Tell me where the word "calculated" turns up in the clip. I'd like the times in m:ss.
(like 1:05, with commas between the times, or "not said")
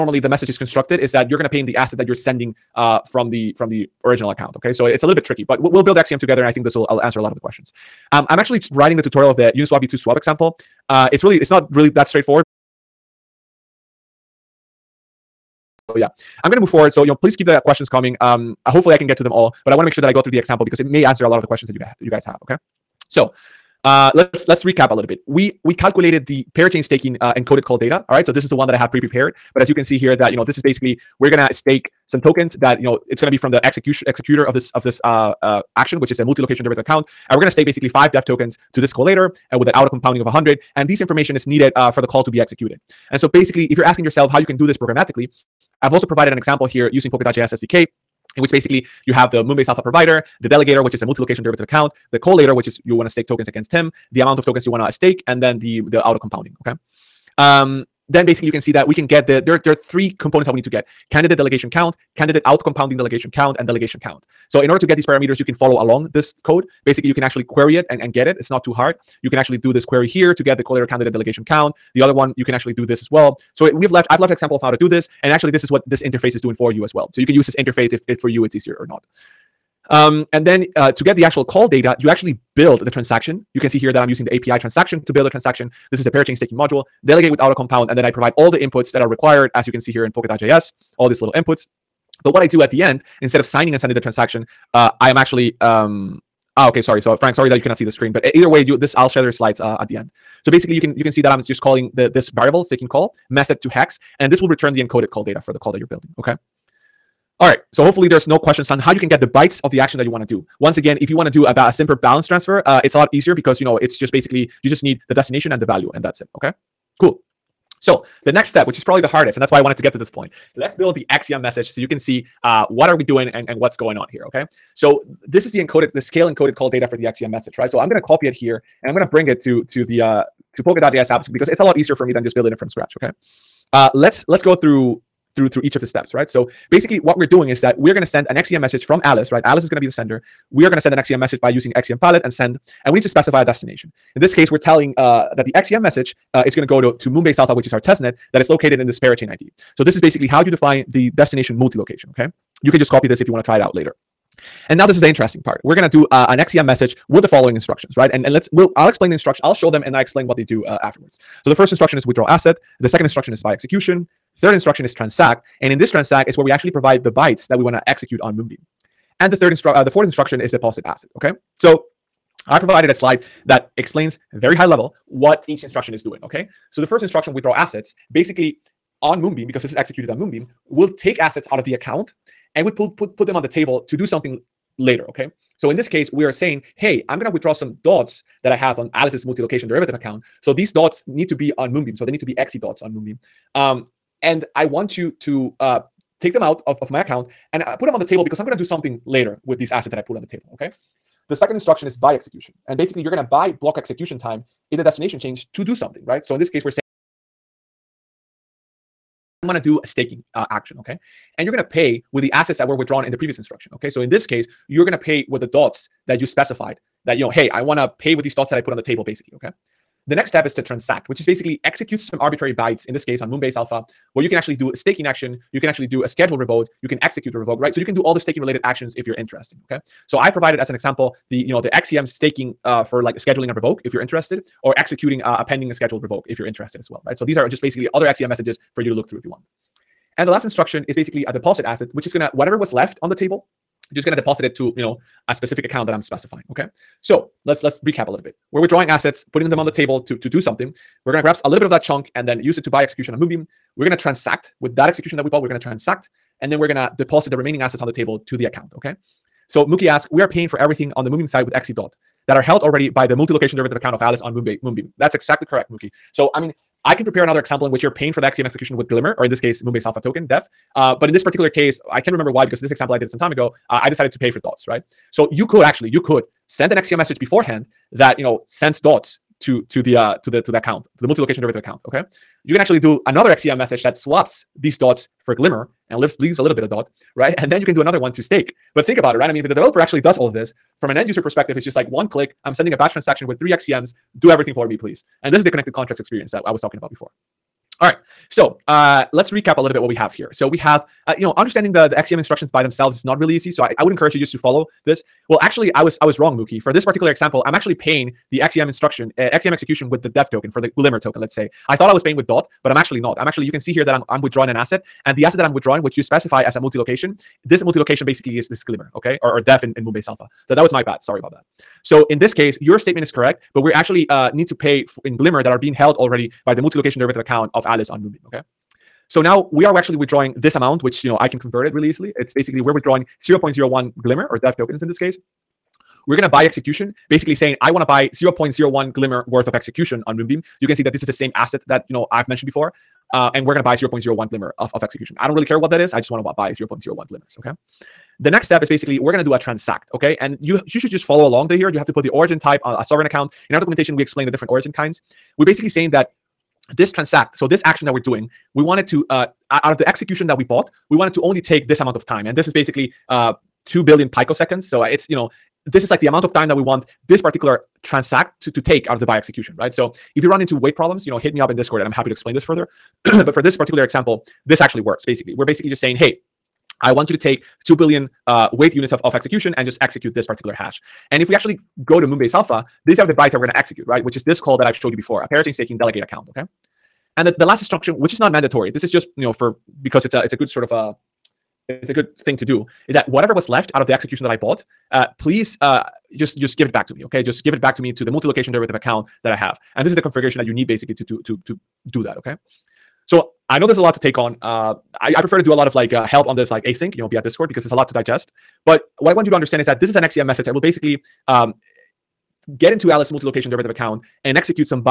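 0:25.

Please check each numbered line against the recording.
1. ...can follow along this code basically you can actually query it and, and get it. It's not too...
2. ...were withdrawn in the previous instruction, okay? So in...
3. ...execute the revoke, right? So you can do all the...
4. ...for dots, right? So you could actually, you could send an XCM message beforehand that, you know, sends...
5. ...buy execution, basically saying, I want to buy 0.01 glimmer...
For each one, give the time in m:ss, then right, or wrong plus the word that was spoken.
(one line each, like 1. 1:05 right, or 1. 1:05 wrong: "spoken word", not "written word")
1. 1:05 right
2. 3:32 right
3. 3:47 right
4. 4:34 right
5. 5:36 right.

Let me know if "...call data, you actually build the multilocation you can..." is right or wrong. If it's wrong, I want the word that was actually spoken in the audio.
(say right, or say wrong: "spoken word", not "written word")
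wrong: "transaction", not "multilocation".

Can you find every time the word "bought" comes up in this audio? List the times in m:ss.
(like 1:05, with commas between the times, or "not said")
4:15, 6:00, 6:34.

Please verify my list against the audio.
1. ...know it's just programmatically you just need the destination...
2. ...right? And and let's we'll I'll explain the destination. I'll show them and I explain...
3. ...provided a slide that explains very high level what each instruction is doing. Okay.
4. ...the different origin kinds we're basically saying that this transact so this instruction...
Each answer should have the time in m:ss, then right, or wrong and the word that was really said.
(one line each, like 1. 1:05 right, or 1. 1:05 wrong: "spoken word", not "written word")
1. 1:53 wrong: "basically", not "programmatically"
2. 2:37 wrong: "instruction", not "destination"
3. 2:52 right
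4. 5:54 wrong: "action", not "instruction".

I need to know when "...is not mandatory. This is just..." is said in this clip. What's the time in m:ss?
6:28.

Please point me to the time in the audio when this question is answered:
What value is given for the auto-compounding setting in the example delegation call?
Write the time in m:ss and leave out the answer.
0:40.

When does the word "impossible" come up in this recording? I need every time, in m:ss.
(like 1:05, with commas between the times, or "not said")
not said.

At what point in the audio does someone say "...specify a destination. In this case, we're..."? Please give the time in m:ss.
2:23.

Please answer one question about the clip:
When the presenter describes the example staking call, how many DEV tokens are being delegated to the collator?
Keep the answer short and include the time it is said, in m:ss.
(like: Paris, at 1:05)
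5, at 0:37.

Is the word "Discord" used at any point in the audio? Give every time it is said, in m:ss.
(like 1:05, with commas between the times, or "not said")
6:11, 6:47.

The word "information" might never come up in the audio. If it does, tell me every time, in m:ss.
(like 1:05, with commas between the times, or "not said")
0:40.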